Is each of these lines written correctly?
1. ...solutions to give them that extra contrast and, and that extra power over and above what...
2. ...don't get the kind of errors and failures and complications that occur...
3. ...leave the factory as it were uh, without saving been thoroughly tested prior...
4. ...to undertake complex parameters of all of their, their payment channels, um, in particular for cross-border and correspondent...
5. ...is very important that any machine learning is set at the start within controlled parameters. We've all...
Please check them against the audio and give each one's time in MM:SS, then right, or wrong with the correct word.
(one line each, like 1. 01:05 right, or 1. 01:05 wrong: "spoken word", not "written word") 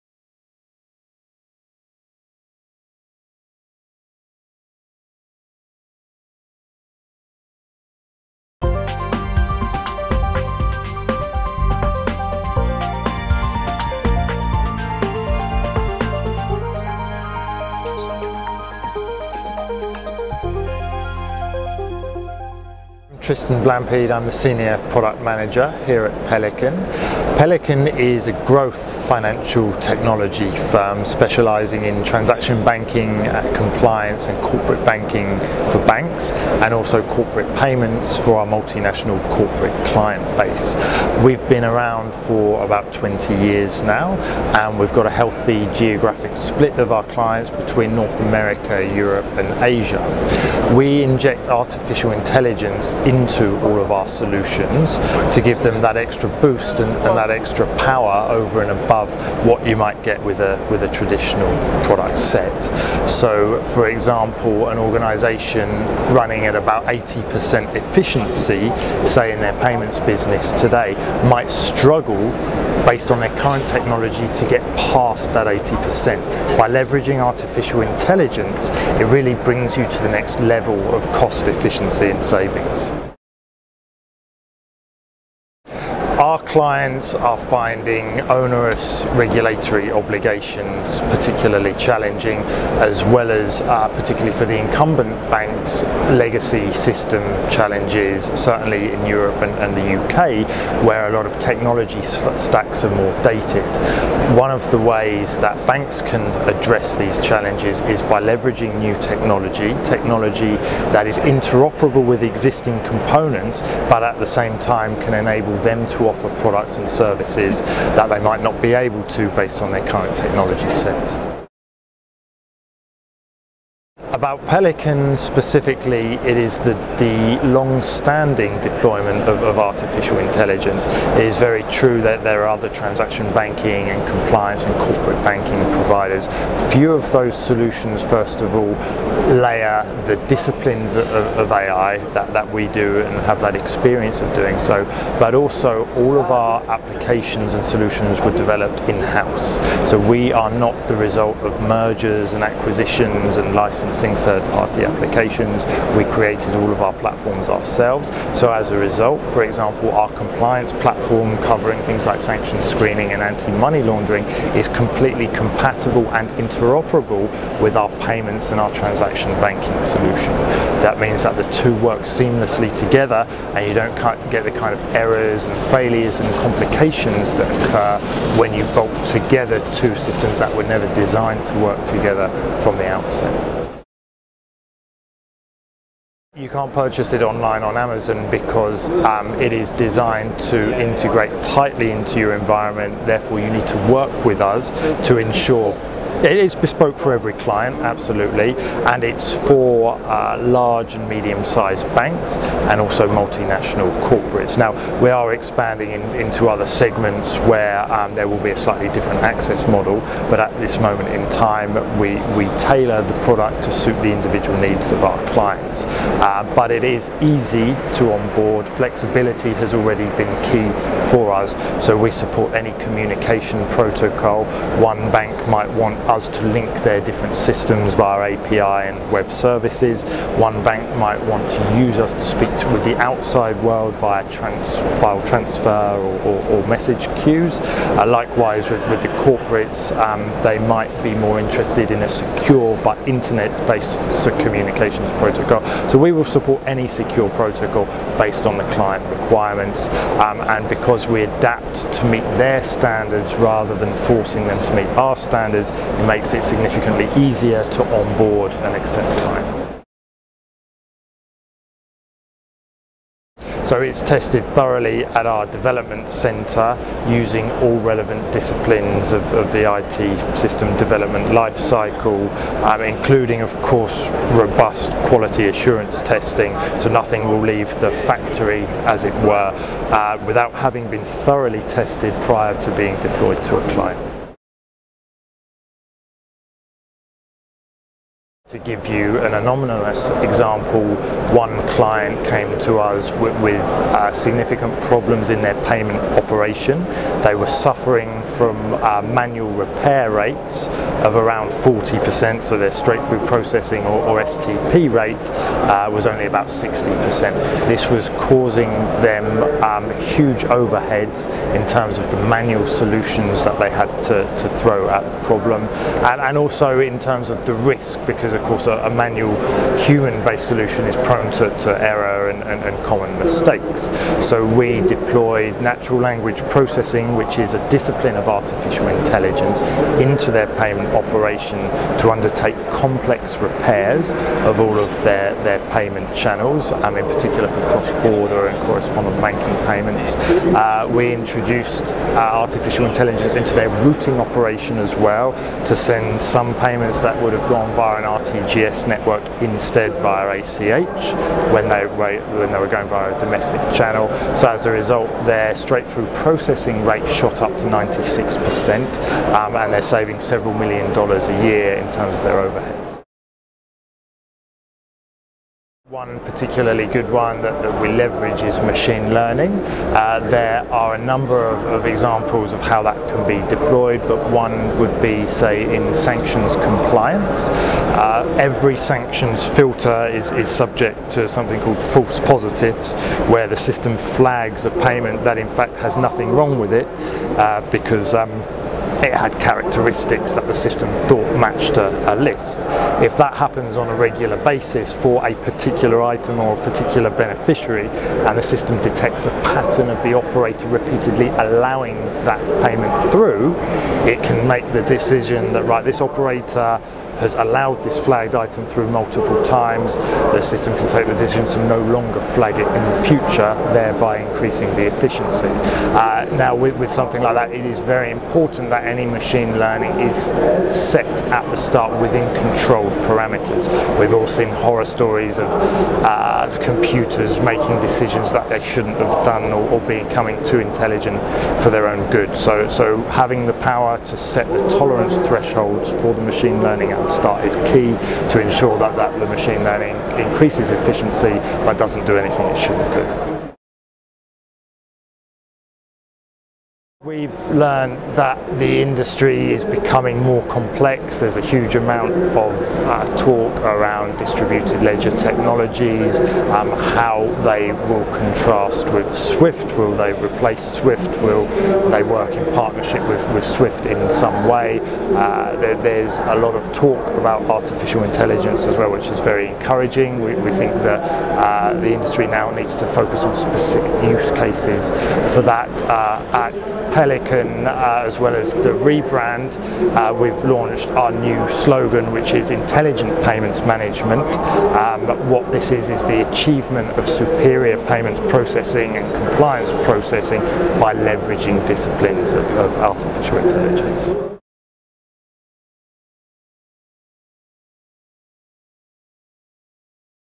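1. 00:54 wrong: "boost", not "contrast"
2. 02:53 right
3. 04:37 wrong: "having", not "saving"
4. 05:31 wrong: "repairs", not "parameters"
5. 06:57 right.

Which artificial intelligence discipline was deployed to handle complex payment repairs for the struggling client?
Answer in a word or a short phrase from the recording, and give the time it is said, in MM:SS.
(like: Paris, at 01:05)
natural language processing, at 05:25.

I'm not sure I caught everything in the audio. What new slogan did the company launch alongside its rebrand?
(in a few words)
Intelligent Payments Management.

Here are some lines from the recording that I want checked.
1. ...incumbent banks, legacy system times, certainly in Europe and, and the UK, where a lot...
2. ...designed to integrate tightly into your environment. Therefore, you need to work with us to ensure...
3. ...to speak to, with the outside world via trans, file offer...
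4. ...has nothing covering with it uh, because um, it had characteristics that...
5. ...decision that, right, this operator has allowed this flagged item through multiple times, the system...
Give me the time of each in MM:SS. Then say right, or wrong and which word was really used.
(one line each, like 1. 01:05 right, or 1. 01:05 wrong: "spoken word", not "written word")
1. 01:34 wrong: "challenges", not "times"
2. 03:09 right
3. 03:52 wrong: "transfer", not "offer"
4. 06:25 wrong: "wrong", not "covering"
5. 06:44 right.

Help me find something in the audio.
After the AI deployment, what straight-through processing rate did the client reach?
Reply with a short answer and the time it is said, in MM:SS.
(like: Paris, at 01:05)
96%, at 05:57.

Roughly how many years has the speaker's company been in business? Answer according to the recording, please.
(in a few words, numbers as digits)
20 years.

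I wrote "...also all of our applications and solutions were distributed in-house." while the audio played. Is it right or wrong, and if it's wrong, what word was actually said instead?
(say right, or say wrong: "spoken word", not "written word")
wrong: "developed", not "distributed".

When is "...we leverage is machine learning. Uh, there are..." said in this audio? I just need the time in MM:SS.
06:07.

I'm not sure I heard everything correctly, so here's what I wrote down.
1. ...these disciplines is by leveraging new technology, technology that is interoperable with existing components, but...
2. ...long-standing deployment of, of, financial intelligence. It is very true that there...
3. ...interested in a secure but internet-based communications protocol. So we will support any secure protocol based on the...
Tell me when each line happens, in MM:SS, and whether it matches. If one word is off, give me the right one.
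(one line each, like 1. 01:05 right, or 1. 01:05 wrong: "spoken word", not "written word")
1. 01:46 wrong: "challenges", not "disciplines"
2. 02:07 wrong: "artificial", not "financial"
3. 04:01 right.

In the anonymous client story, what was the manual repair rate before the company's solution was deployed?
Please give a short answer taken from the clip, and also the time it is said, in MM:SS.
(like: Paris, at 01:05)
40%, at 05:01.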